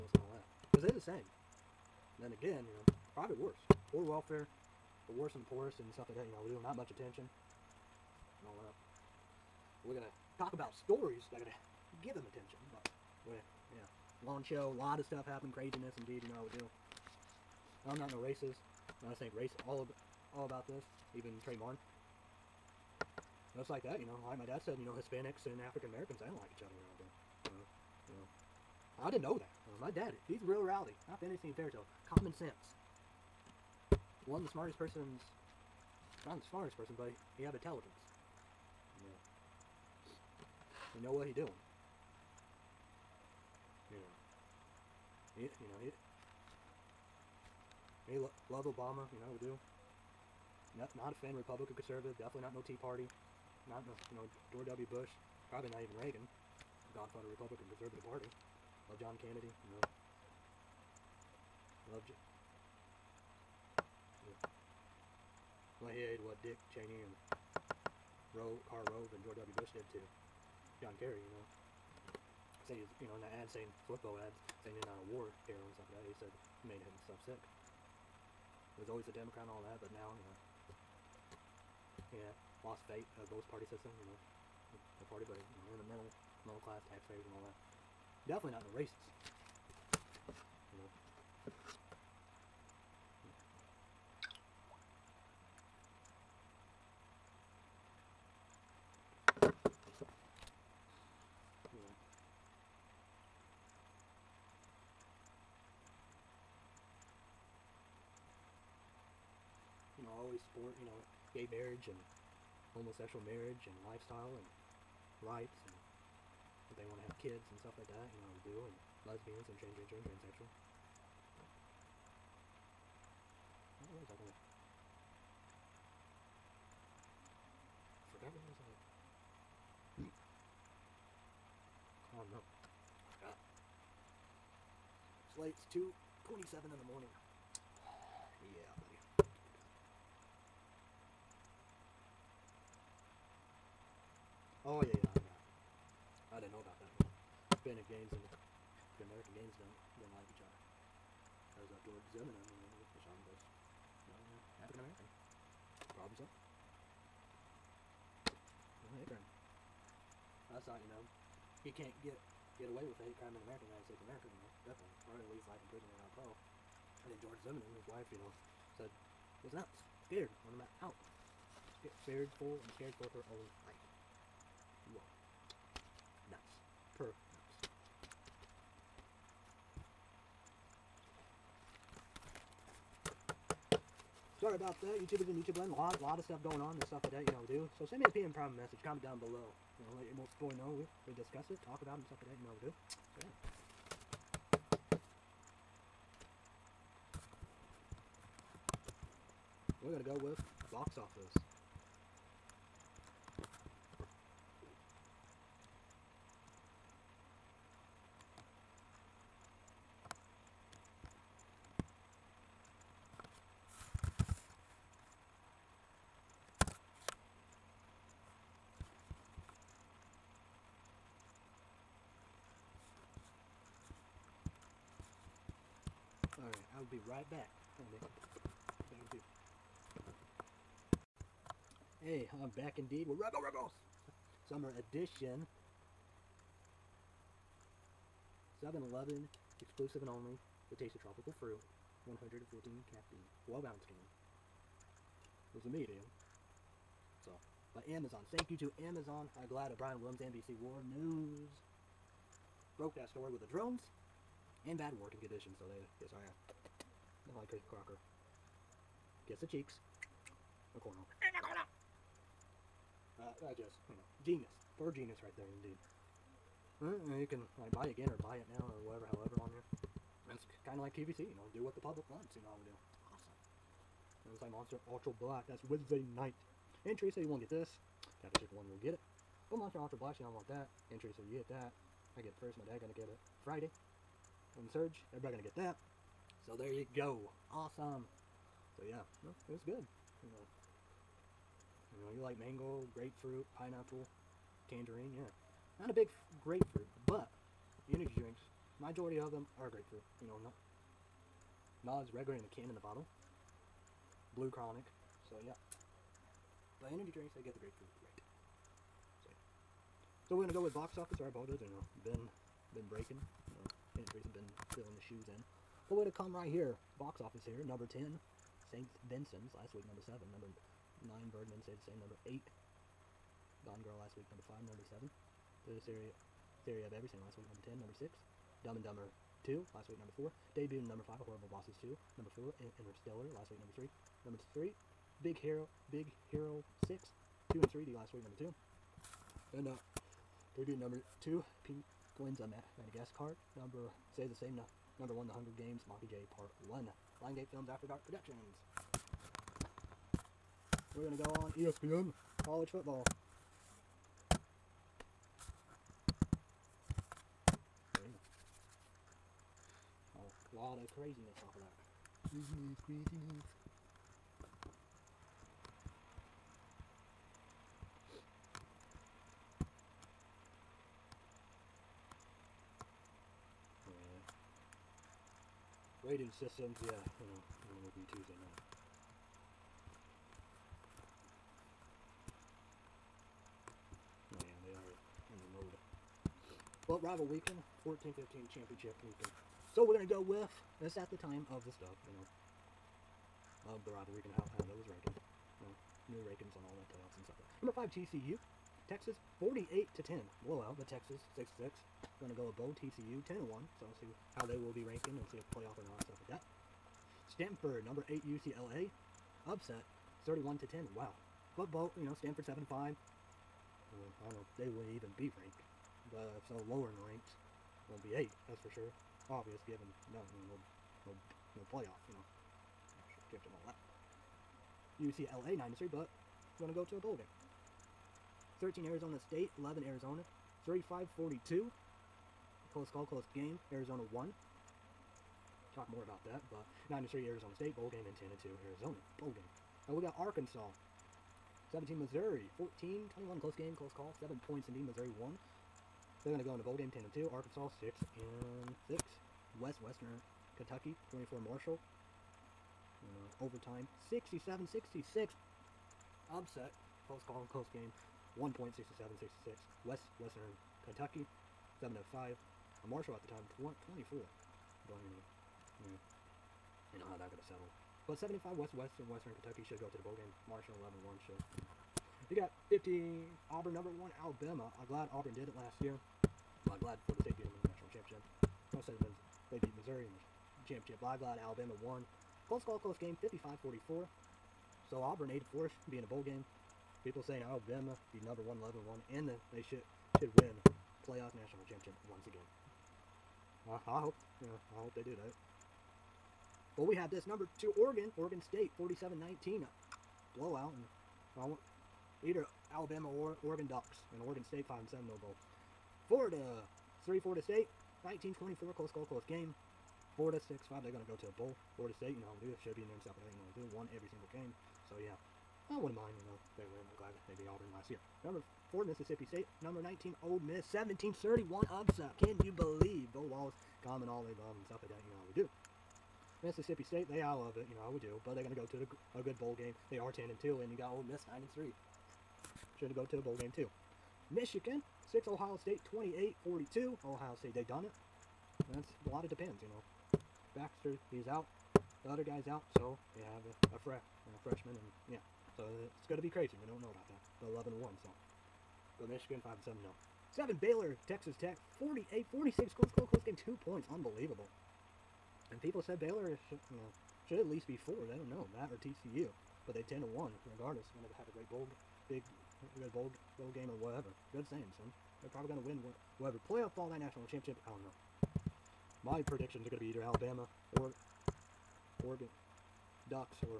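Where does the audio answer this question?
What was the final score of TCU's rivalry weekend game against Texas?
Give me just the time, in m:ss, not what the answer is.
6:39.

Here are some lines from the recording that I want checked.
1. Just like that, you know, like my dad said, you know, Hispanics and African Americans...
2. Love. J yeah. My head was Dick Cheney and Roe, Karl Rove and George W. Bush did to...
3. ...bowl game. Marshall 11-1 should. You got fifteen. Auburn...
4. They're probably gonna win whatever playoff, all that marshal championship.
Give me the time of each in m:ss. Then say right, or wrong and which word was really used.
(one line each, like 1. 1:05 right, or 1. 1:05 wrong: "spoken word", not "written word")
1. 0:23 right
2. 1:01 right
3. 7:50 right
4. 9:25 wrong: "national", not "marshal".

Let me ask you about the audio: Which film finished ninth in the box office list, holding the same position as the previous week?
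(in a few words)
Birdman.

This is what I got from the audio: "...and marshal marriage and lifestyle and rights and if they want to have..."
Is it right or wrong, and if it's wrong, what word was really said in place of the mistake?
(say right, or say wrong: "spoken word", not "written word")
wrong: "homosexual", not "marshal".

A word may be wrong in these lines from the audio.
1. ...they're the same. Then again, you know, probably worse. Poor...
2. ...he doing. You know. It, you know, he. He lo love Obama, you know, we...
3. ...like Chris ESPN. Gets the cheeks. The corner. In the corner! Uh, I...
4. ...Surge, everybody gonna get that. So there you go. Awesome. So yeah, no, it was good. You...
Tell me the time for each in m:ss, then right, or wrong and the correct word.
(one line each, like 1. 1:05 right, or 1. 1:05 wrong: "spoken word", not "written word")
1. 0:00 right
2. 0:41 right
3. 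4:17 wrong: "Crocker", not "ESPN"
4. 4:44 right.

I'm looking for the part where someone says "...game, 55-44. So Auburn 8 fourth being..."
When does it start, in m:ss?
8:03.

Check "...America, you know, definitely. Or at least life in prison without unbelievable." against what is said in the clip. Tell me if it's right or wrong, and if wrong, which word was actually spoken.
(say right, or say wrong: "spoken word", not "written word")
wrong: "parole", not "unbelievable".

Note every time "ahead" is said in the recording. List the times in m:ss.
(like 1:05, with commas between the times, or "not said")
not said.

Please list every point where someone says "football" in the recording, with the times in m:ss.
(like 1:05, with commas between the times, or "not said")
1:13, 5:52.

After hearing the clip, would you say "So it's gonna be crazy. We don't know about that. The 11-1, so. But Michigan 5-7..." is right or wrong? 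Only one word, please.
right.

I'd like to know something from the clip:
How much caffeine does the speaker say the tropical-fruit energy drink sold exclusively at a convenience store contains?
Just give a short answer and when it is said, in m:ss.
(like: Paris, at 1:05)
114, at 4:02.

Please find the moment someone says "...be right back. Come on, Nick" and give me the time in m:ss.
3:46.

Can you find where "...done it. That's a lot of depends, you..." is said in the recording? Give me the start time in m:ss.
8:57.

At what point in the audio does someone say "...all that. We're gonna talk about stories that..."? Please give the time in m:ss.
0:08.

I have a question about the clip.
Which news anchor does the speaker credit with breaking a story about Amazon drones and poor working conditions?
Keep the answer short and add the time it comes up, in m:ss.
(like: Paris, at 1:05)
Brian Williams, at 4:09.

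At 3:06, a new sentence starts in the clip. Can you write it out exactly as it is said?
There's stuff like that you know do.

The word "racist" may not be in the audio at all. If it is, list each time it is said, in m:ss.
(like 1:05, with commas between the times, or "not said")
0:18, 1:28.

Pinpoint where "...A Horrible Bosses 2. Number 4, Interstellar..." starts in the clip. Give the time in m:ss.
5:31.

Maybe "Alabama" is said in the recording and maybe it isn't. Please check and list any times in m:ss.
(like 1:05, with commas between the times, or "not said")
7:54, 8:01, 8:07, 8:22, 9:30.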